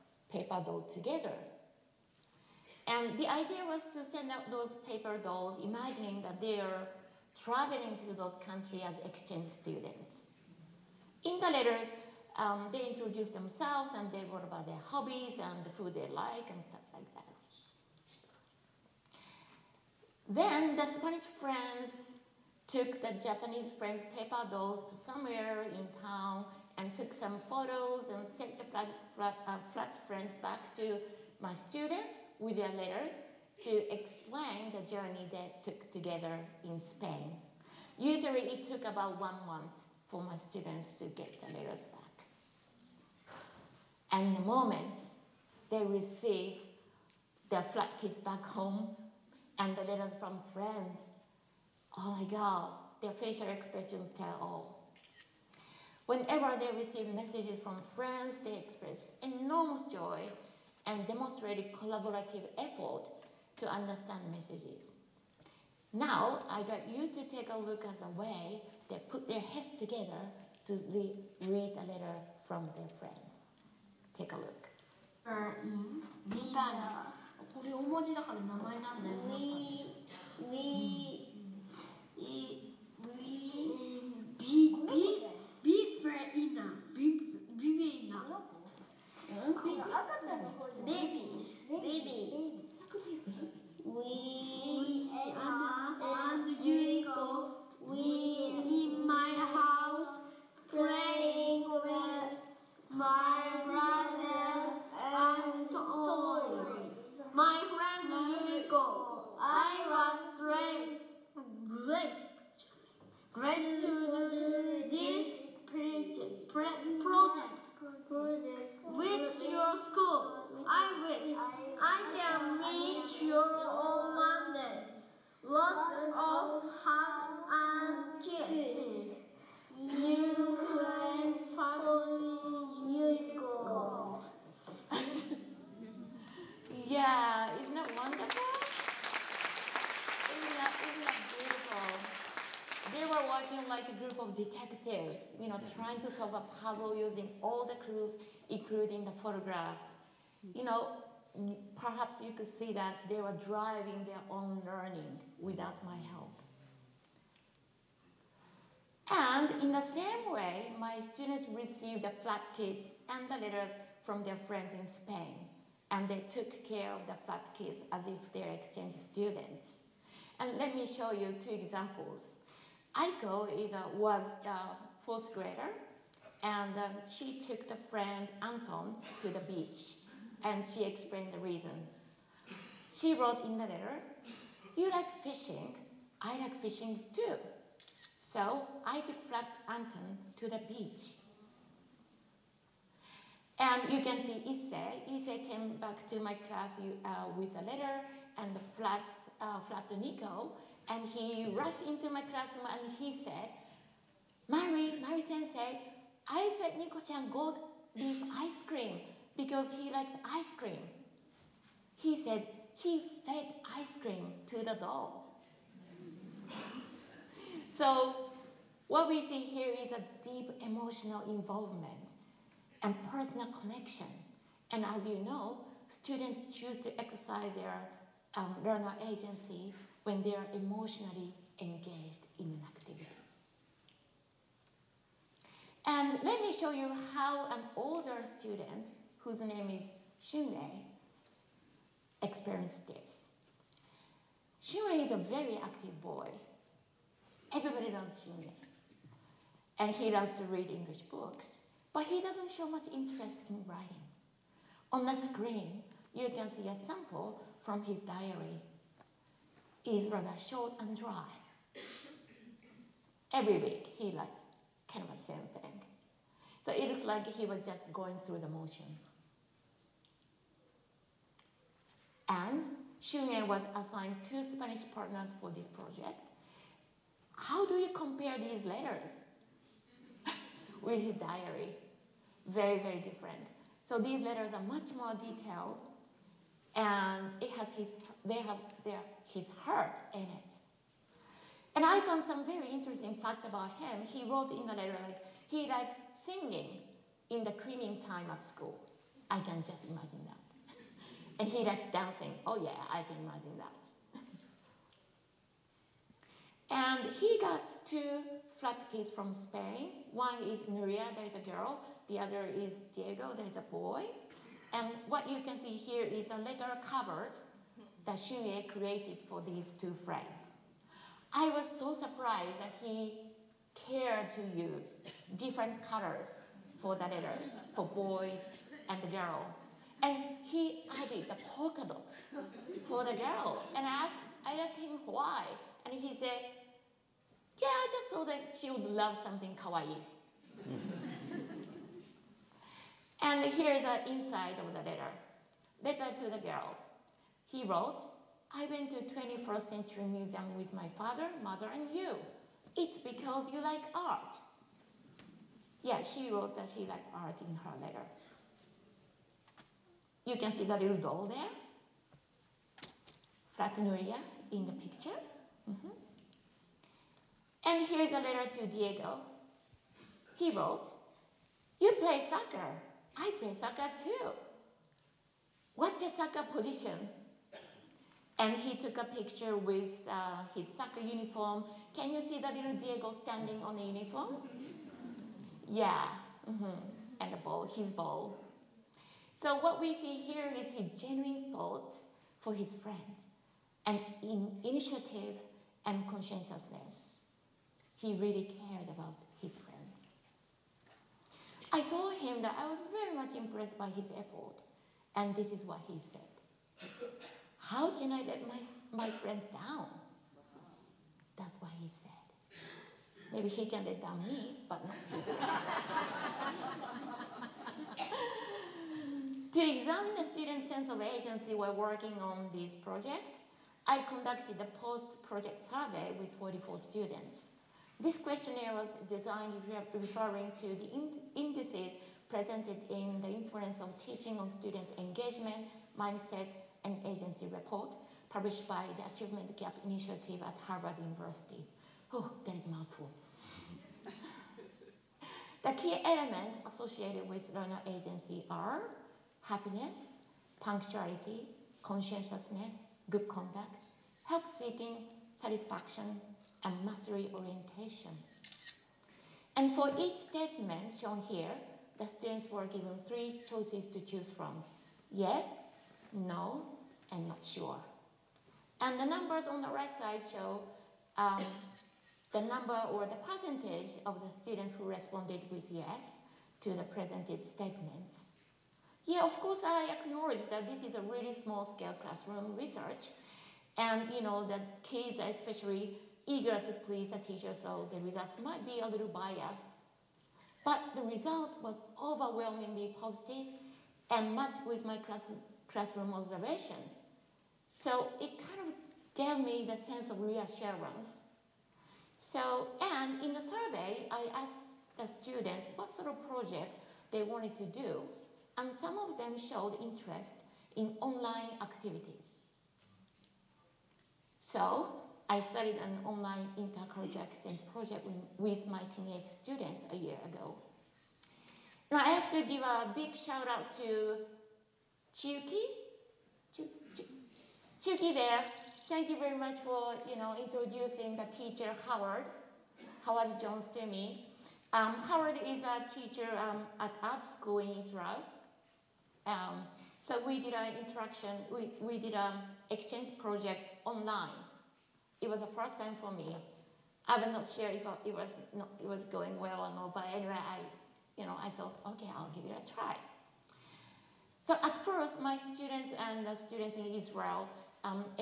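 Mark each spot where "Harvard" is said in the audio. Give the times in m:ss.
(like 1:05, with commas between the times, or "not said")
7:20.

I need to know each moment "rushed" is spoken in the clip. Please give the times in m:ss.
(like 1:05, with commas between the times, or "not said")
3:21.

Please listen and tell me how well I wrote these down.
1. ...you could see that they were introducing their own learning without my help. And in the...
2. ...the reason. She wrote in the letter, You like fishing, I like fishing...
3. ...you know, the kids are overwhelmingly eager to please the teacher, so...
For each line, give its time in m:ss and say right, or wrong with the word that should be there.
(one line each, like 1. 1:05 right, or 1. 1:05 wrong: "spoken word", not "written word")
1. 2:32 wrong: "driving", not "introducing"
2. 3:01 right
3. 8:04 wrong: "especially", not "overwhelmingly".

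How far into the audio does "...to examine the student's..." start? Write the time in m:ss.
6:59.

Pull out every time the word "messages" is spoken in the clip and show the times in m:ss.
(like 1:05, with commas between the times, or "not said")
0:57, 1:04.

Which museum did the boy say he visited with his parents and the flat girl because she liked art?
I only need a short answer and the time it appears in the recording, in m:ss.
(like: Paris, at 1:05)
21st Century Museum, at 5:49.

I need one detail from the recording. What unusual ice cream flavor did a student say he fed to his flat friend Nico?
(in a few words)
Gold leaf.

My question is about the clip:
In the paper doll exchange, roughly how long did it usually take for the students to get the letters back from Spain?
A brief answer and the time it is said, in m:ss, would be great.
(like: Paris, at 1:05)
1 month, at 0:38.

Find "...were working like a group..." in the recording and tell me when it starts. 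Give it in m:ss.
2:23.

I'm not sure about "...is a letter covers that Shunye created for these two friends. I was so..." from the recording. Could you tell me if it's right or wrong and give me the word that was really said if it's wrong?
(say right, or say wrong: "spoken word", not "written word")
right.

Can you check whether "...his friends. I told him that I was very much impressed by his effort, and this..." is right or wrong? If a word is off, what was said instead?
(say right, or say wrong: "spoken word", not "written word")
right.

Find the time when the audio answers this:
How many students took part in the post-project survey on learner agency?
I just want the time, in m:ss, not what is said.
7:06.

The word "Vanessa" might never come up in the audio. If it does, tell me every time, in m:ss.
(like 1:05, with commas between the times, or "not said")
not said.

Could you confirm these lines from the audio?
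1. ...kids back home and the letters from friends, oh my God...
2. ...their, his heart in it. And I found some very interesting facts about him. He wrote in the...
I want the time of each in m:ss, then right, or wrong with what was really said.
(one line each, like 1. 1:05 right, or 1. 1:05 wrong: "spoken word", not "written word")
1. 0:47 right
2. 4:48 right.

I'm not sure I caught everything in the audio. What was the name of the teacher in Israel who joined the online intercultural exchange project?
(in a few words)
Howard Jones.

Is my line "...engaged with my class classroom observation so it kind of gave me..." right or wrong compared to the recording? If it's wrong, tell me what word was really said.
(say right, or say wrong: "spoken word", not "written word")
wrong: "matched", not "engaged".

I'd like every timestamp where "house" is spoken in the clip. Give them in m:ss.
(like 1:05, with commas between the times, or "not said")
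1:39.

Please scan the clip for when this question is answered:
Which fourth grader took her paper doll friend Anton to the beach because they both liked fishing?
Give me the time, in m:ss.
2:52.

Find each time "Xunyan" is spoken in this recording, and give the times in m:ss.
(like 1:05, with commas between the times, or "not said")
4:32.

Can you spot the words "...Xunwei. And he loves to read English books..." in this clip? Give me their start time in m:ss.
4:08.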